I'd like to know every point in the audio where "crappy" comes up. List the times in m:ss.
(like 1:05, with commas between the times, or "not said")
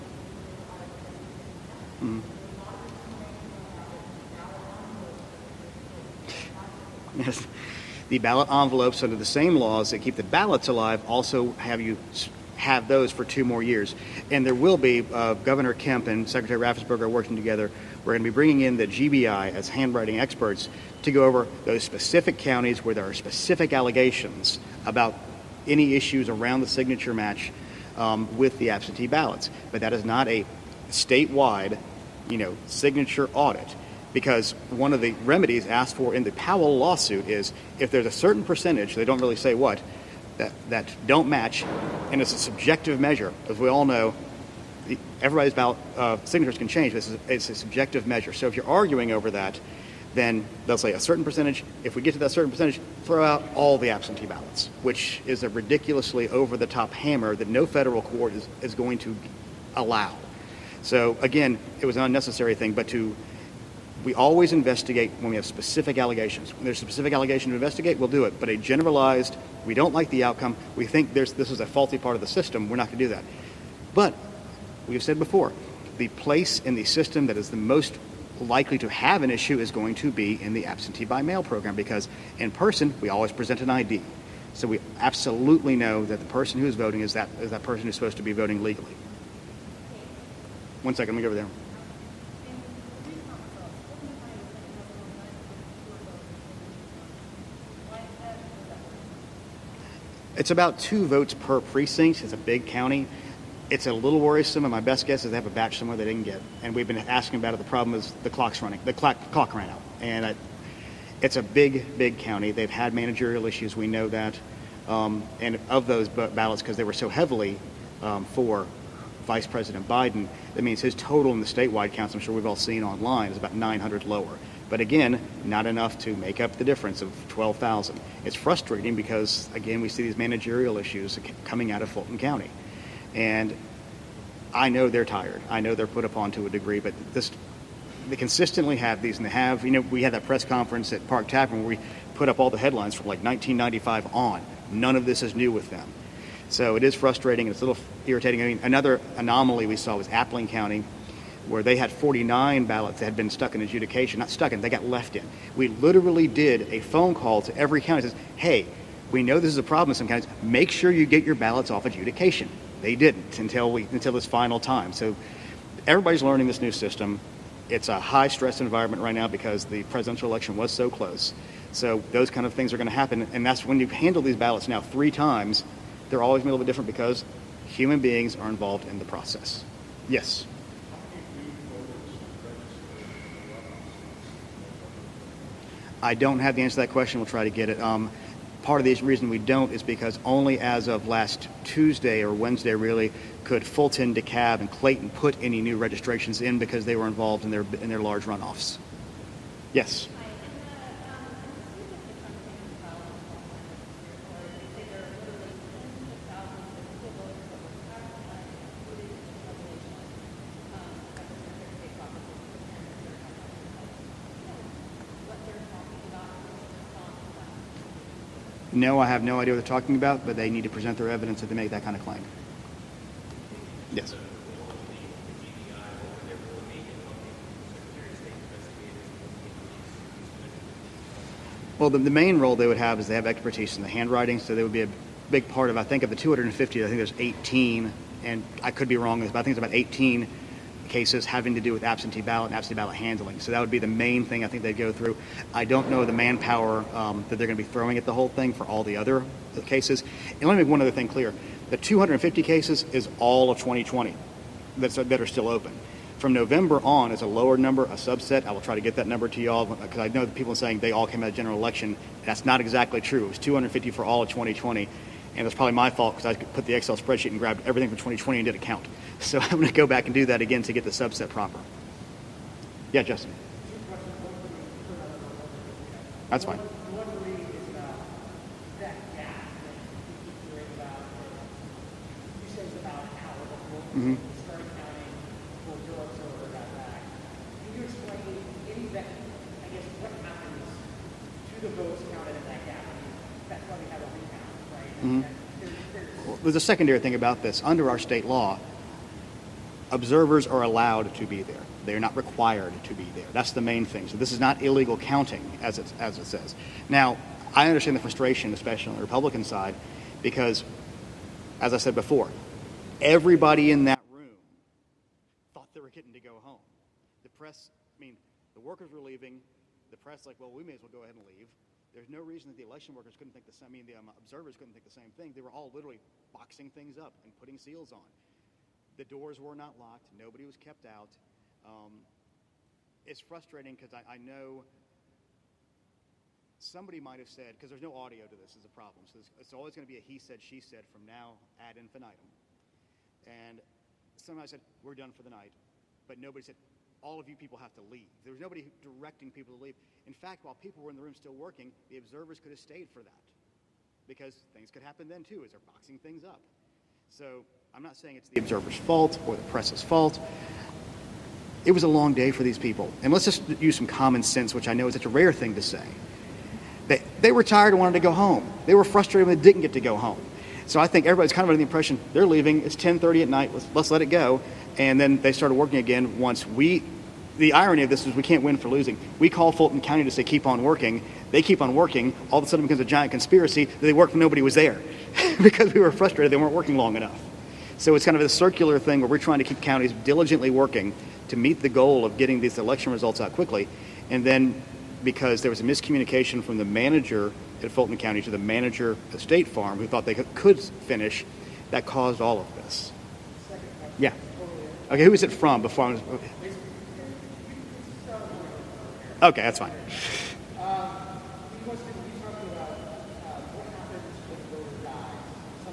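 not said.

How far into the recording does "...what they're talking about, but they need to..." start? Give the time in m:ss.
3:39.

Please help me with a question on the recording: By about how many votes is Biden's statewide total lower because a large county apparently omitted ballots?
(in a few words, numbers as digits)
900.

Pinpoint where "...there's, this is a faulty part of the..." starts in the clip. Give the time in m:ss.
1:11.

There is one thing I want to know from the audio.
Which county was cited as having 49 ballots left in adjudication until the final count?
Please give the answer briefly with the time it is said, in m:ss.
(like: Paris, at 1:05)
Appling County, at 2:30.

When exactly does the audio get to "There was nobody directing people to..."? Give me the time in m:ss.
5:48.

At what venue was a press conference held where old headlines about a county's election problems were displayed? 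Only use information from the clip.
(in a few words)
Park Tavern.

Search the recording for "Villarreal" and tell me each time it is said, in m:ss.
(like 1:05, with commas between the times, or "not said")
not said.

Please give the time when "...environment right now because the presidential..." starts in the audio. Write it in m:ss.
2:48.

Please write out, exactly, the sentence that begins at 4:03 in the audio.
So that would be the main thing I think they'd go through.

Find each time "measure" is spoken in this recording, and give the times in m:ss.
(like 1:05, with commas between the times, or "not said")
0:43, 0:48.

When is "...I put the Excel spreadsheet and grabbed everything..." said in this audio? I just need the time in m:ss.
4:26.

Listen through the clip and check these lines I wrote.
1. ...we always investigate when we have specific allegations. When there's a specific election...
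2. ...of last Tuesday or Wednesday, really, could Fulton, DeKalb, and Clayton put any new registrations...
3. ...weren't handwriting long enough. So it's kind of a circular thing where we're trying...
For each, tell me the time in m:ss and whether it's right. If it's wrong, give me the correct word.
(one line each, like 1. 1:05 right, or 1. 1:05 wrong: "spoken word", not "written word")
1. 1:04 wrong: "allegation", not "election"
2. 3:10 right
3. 6:26 wrong: "working", not "handwriting".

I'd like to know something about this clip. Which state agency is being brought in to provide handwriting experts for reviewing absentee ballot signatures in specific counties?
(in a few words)
GBI.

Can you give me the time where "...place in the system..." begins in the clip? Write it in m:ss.
1:16.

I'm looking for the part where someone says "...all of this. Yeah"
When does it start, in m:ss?
6:42.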